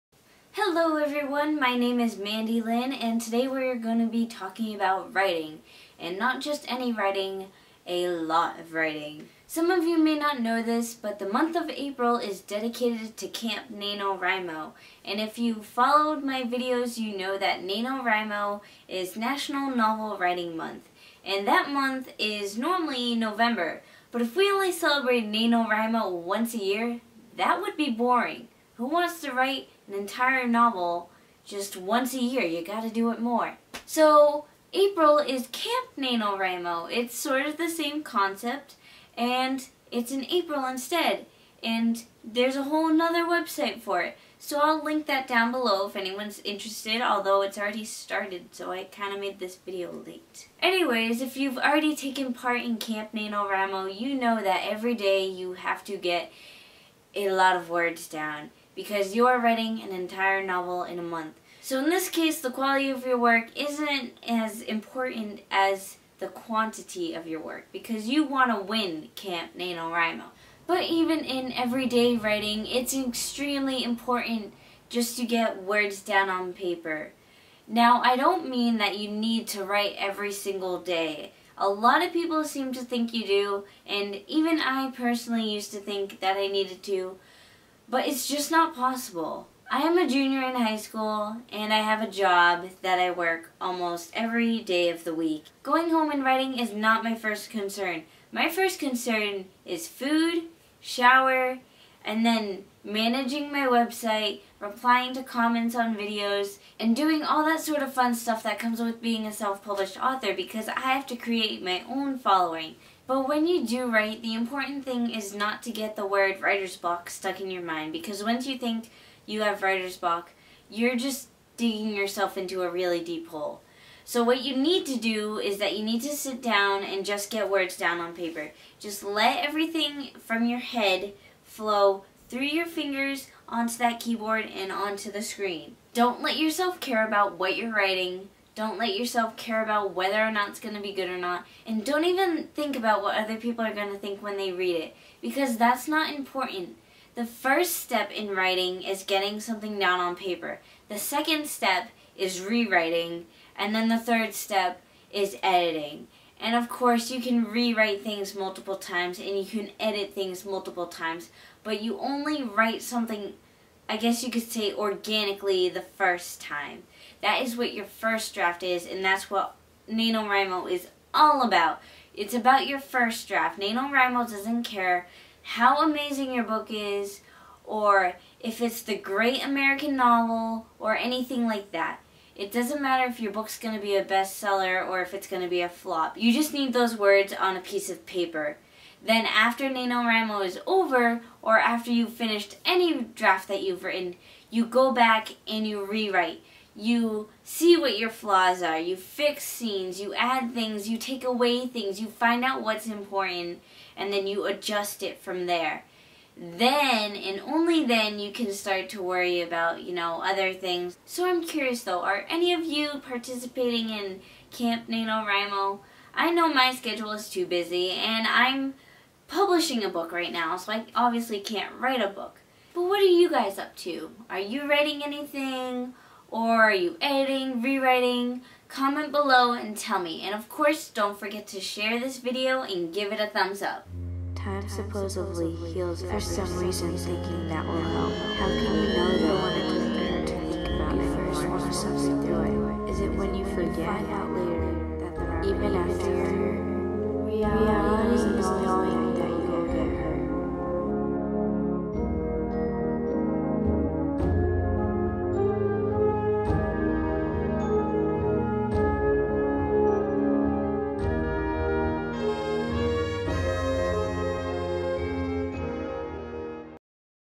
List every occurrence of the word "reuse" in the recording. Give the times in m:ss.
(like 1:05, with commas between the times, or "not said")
not said.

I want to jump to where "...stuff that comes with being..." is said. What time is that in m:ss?
1:48.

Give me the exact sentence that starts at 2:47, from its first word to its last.
That is what your first draft is, and that's what NaNoWriMo is all about.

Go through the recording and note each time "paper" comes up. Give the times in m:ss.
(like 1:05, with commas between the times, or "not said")
1:16, 2:08, 2:30, 3:08.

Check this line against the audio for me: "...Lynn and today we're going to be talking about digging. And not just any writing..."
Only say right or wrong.
wrong.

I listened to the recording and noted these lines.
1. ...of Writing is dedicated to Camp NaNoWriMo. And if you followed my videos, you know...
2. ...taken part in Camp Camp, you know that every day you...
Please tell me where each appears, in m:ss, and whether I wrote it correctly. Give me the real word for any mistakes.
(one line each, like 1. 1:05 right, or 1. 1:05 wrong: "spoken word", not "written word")
1. 0:11 wrong: "April", not "Writing"
2. 0:51 wrong: "NaNoWriMo", not "Camp".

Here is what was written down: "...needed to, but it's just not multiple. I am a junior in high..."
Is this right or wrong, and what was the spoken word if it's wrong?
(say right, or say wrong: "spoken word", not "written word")
wrong: "possible", not "multiple".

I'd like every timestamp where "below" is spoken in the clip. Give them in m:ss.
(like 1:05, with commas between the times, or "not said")
0:45, 3:49.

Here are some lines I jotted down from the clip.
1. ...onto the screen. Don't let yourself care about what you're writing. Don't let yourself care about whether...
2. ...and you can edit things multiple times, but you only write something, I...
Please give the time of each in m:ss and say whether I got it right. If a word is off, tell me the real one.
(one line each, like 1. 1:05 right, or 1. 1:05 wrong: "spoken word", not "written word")
1. 2:14 right
2. 2:39 right.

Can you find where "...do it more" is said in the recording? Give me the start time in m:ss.
0:32.